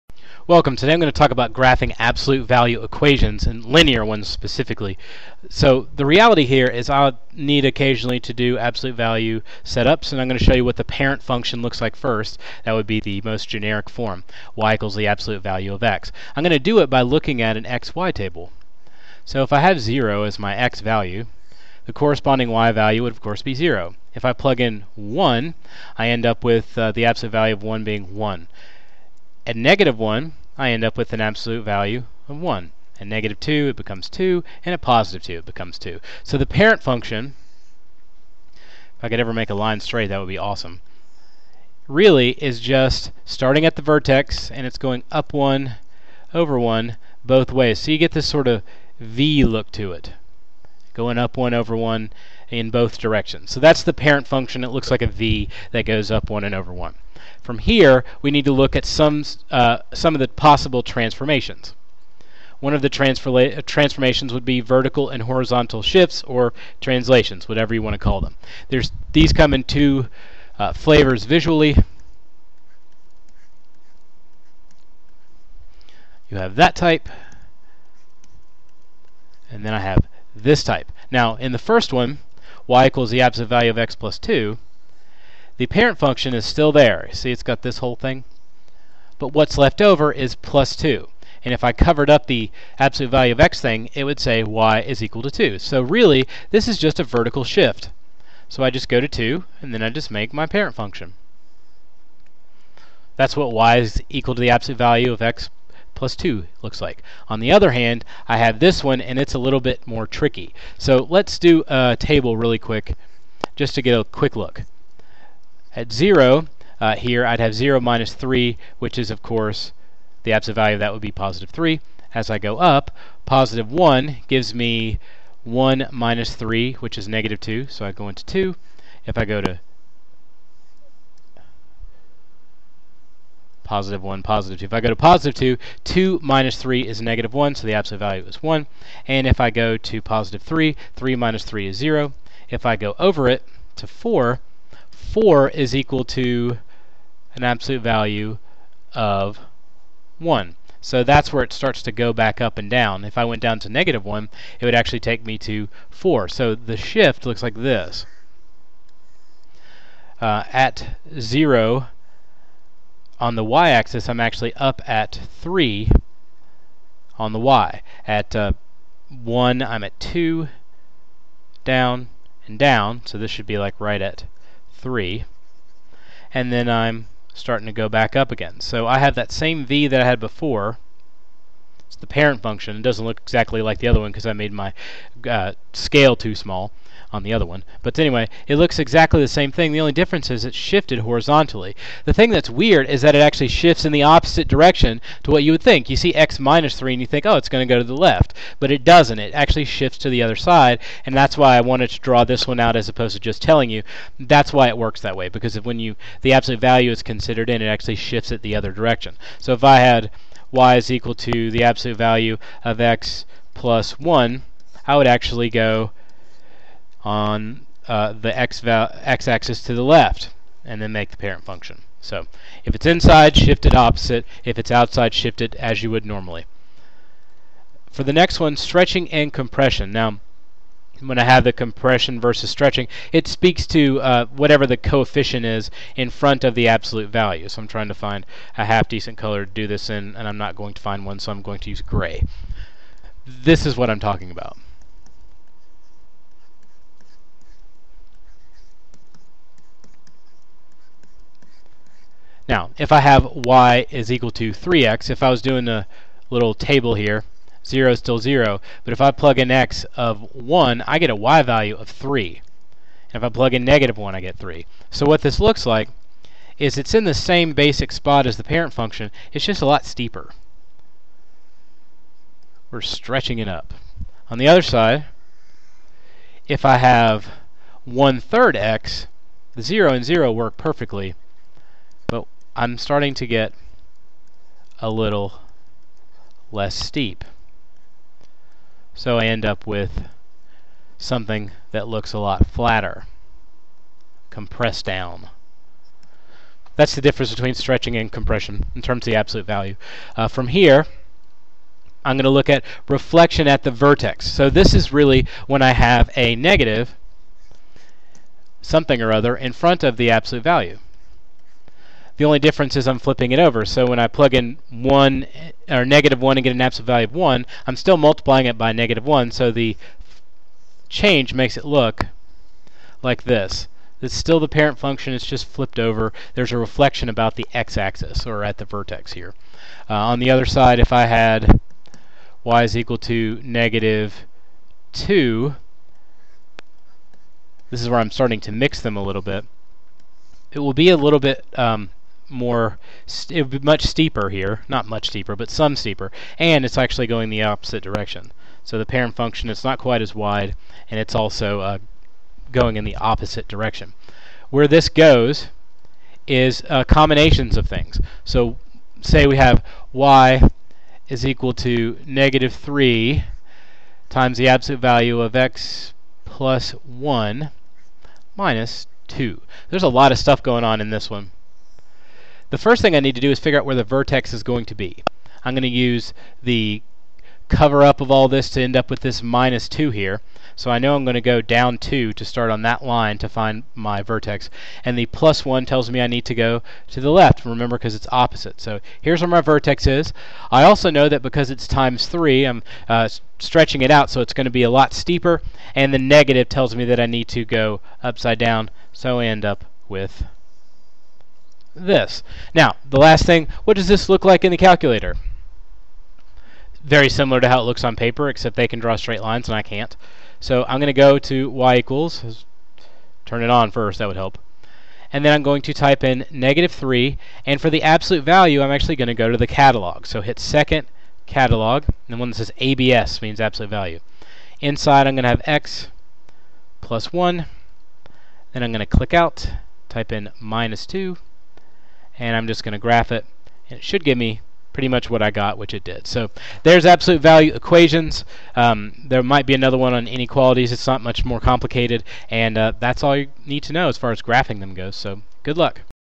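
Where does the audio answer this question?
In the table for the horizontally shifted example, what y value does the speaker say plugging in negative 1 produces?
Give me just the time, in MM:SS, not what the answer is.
02:34.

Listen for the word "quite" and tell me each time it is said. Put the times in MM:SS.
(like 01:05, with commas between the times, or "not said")
05:49.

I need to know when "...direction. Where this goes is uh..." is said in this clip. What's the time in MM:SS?
05:53.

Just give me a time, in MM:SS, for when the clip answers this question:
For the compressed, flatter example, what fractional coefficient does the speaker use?
04:37.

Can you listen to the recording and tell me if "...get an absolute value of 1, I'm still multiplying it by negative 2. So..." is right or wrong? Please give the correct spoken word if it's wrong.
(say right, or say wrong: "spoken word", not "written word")
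wrong: "1", not "2".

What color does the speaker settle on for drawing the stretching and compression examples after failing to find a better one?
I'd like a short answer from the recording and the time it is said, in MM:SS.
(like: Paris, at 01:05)
gray, at 04:01.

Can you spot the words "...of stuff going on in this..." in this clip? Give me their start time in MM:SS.
06:10.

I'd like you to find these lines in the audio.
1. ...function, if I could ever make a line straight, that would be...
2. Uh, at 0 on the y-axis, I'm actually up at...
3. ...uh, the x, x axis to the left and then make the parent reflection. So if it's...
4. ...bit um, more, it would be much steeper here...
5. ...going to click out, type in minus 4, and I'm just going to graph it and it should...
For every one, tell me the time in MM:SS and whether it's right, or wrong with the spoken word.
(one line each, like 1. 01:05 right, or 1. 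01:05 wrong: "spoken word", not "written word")
1. 00:36 right
2. 02:40 right
3. 03:37 wrong: "function", not "reflection"
4. 05:41 right
5. 07:08 wrong: "2", not "4".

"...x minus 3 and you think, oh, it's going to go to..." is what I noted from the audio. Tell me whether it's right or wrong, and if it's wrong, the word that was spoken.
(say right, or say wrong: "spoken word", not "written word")
right.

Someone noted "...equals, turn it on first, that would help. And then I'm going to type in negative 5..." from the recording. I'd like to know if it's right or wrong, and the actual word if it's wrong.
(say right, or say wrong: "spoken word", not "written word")
wrong: "3", not "5".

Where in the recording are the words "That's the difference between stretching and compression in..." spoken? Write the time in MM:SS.
04:56.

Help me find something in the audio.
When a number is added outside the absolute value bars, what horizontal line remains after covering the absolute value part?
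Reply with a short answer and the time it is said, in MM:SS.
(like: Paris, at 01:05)
y is equal to 2, at 01:34.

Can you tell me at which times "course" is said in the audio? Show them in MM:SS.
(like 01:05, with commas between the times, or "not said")
00:23, 01:59.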